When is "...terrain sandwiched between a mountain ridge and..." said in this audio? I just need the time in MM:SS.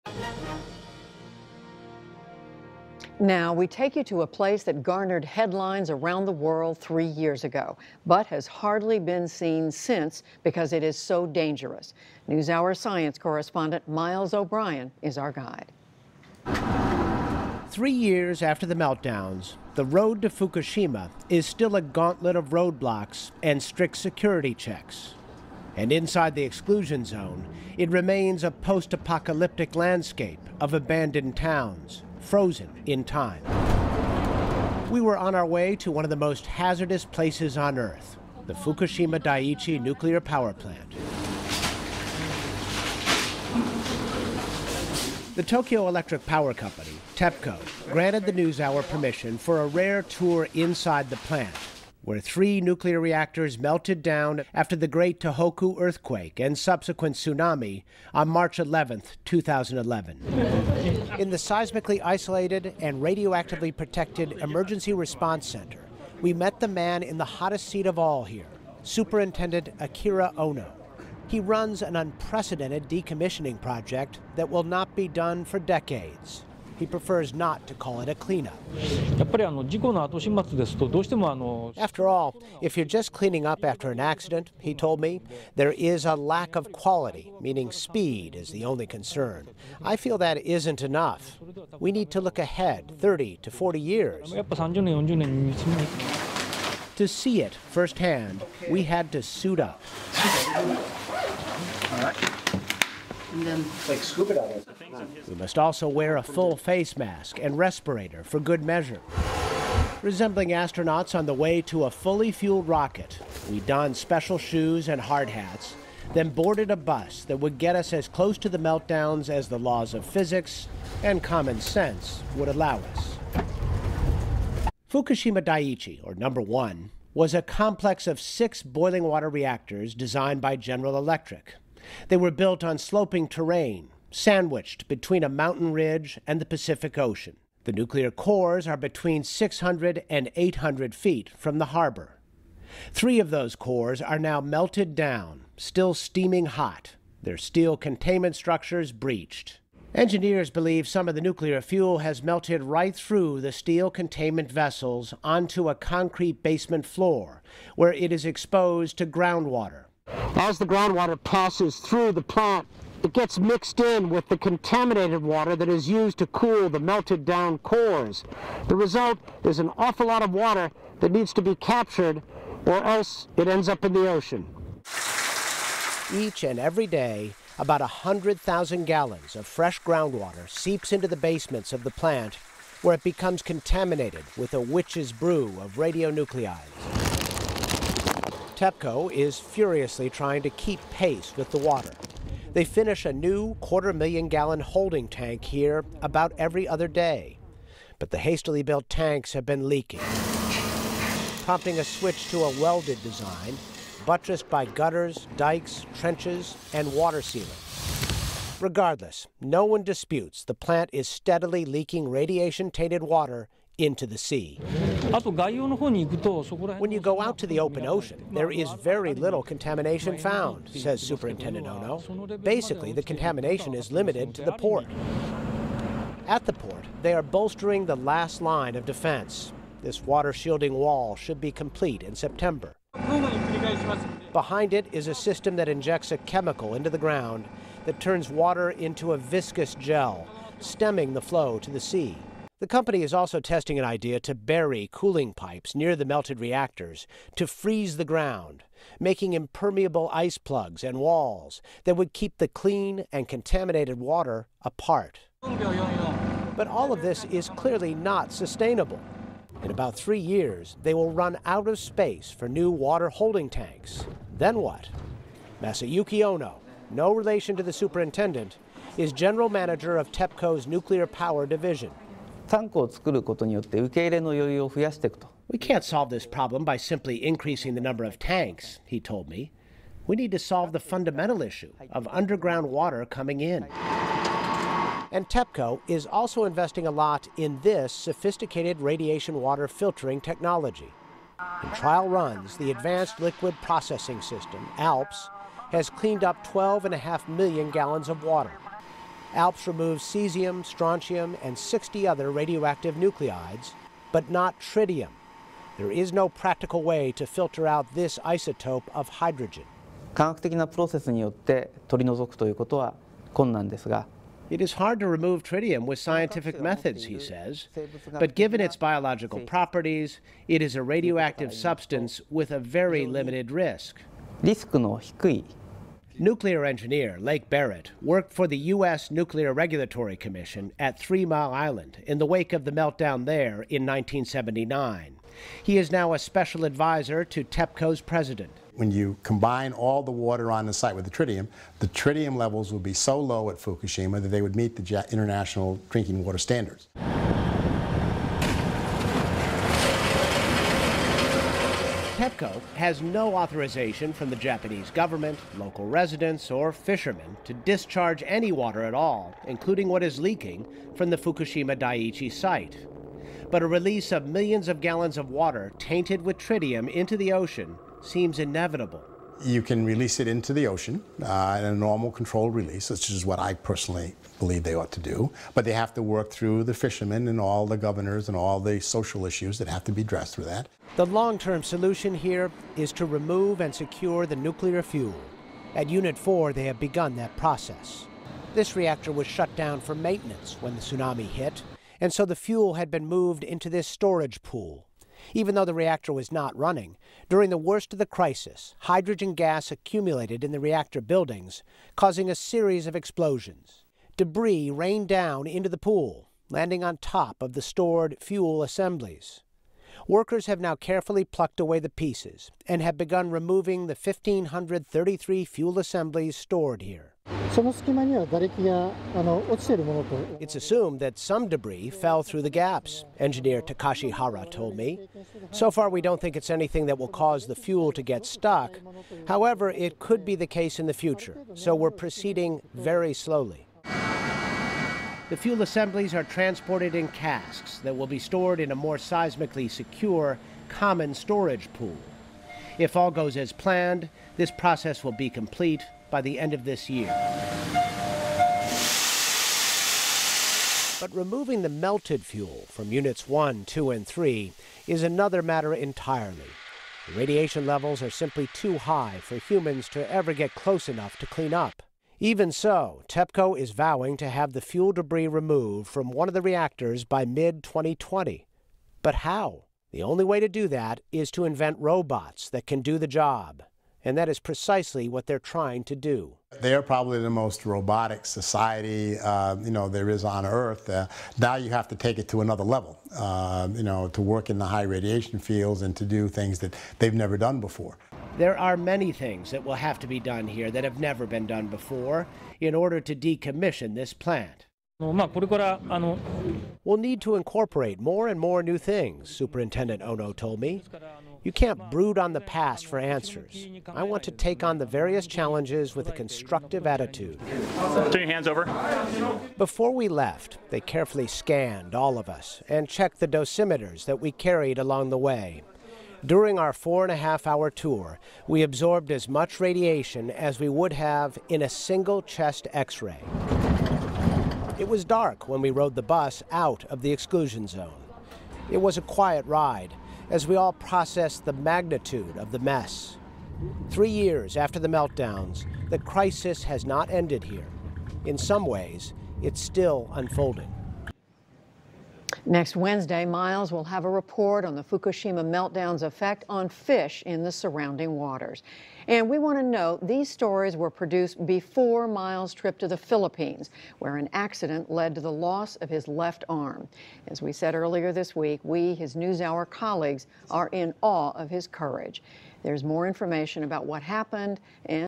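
02:13.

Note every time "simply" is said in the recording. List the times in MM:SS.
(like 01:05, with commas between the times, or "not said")
04:36, 07:38.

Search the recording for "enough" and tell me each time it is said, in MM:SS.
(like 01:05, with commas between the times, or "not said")
01:30, 07:40.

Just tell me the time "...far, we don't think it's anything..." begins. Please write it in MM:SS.
07:05.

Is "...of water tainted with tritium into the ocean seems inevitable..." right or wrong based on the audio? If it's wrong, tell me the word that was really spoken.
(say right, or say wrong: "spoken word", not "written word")
right.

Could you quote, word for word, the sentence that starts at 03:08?
TEPCO is furiously trying to keep pace with the water.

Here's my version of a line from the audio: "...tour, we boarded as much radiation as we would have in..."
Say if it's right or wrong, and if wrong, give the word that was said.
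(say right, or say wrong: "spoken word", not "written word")
wrong: "absorbed", not "boarded".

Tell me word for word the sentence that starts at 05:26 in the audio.
Nuclear engineer Lake Barrett worked for the U.S.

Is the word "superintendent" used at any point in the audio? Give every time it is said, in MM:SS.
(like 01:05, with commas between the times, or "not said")
01:08, 03:41, 04:27, 08:19.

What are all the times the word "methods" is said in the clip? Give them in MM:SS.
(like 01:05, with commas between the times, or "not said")
05:16.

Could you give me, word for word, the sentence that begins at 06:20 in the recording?
The long-term solution here is to remove and secure the nuclear fuel.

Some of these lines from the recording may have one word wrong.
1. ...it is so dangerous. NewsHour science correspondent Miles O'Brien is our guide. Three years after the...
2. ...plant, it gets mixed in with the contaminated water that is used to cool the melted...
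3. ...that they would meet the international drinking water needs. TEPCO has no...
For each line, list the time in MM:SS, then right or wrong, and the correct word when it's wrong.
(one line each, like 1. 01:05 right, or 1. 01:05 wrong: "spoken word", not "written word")
1. 00:10 right
2. 02:42 right
3. 05:44 wrong: "standards", not "needs".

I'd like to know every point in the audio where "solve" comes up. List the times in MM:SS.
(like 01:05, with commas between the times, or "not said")
04:35, 04:40.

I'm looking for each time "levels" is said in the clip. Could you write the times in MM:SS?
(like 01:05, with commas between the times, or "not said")
05:42, 07:37, 08:02.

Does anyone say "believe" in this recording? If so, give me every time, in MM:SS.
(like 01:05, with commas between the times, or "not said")
02:30, 06:14.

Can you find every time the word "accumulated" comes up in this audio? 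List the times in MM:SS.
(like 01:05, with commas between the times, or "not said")
06:39.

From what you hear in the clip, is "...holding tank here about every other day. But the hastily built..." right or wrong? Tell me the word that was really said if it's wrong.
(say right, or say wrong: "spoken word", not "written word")
right.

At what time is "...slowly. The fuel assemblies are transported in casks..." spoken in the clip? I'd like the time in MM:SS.
07:13.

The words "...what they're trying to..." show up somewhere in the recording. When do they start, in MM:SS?
07:55.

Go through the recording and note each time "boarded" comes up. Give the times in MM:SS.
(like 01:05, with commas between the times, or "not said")
01:56.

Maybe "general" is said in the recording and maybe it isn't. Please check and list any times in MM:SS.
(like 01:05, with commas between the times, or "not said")
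02:10, 04:29.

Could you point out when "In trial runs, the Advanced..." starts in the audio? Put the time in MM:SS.
04:51.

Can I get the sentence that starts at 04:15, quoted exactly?
But all of this is clearly not sustainable.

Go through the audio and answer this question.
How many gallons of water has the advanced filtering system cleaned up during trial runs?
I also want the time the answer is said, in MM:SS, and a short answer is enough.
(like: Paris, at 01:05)
12.5 million gallons, at 04:56.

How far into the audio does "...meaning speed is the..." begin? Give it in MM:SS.
01:27.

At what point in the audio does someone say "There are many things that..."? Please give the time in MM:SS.
08:08.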